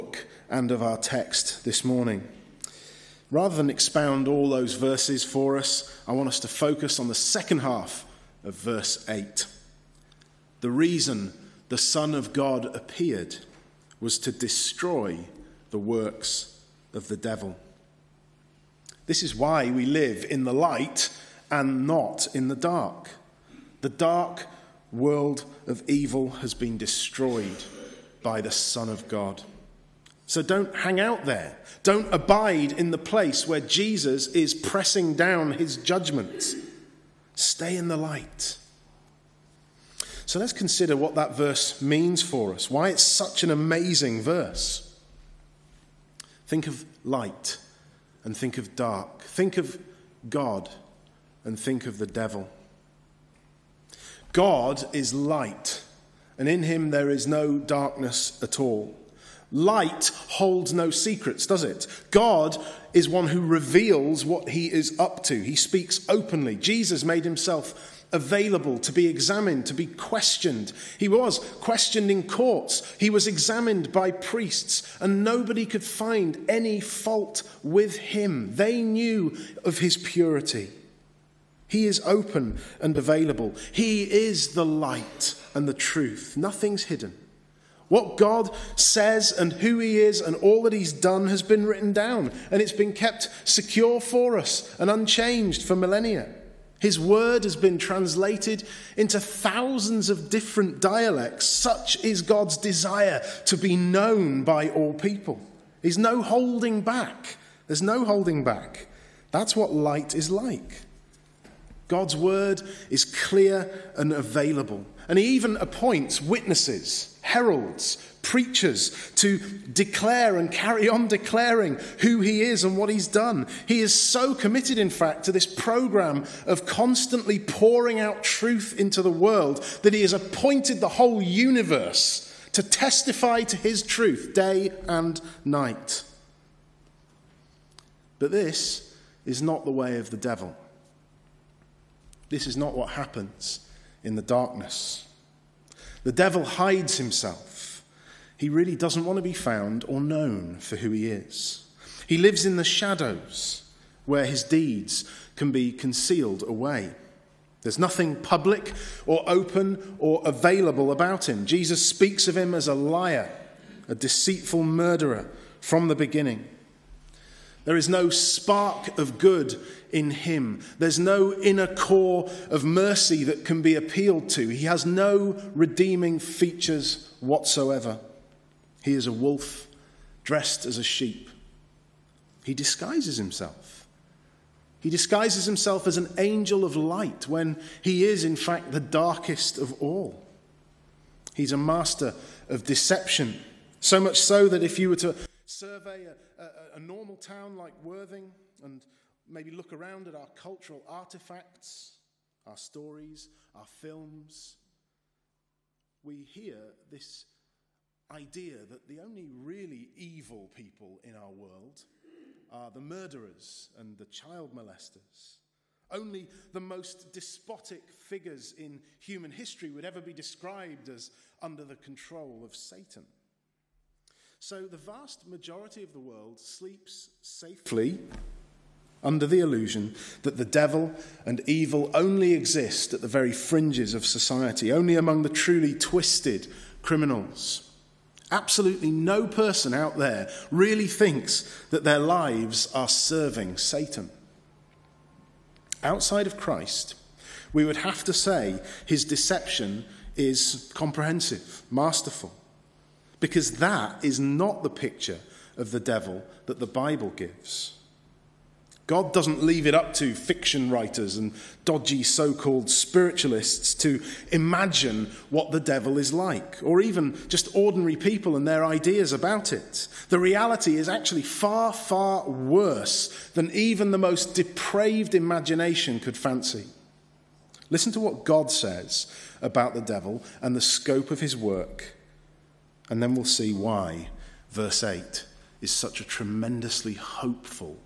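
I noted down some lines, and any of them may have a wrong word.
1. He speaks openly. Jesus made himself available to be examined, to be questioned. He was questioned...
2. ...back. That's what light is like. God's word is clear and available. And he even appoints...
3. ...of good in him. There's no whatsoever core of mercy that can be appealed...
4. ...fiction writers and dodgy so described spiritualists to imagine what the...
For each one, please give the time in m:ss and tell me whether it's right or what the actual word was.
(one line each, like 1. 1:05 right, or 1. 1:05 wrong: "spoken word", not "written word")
1. 1:05 right
2. 1:48 right
3. 2:48 wrong: "inner", not "whatsoever"
4. 4:20 wrong: "called", not "described".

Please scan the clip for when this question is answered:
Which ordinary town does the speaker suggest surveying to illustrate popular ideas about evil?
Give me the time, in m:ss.
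3:17.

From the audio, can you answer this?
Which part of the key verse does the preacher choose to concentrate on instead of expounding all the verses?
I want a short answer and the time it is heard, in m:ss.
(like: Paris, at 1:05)
second half of verse 8, at 0:07.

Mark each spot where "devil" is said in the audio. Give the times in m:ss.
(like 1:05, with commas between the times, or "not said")
0:17, 0:52, 2:20, 2:26, 3:50, 4:15, 4:25, 4:39.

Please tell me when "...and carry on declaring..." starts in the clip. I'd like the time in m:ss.
2:00.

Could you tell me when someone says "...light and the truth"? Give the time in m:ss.
1:24.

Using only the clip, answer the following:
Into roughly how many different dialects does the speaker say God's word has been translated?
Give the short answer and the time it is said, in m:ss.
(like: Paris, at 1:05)
thousands, at 1:39.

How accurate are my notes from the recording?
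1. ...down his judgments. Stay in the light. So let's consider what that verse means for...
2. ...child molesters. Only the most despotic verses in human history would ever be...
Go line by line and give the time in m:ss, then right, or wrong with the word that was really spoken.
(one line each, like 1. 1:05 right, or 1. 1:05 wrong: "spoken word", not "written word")
1. 0:35 right
2. 3:34 wrong: "figures", not "verses".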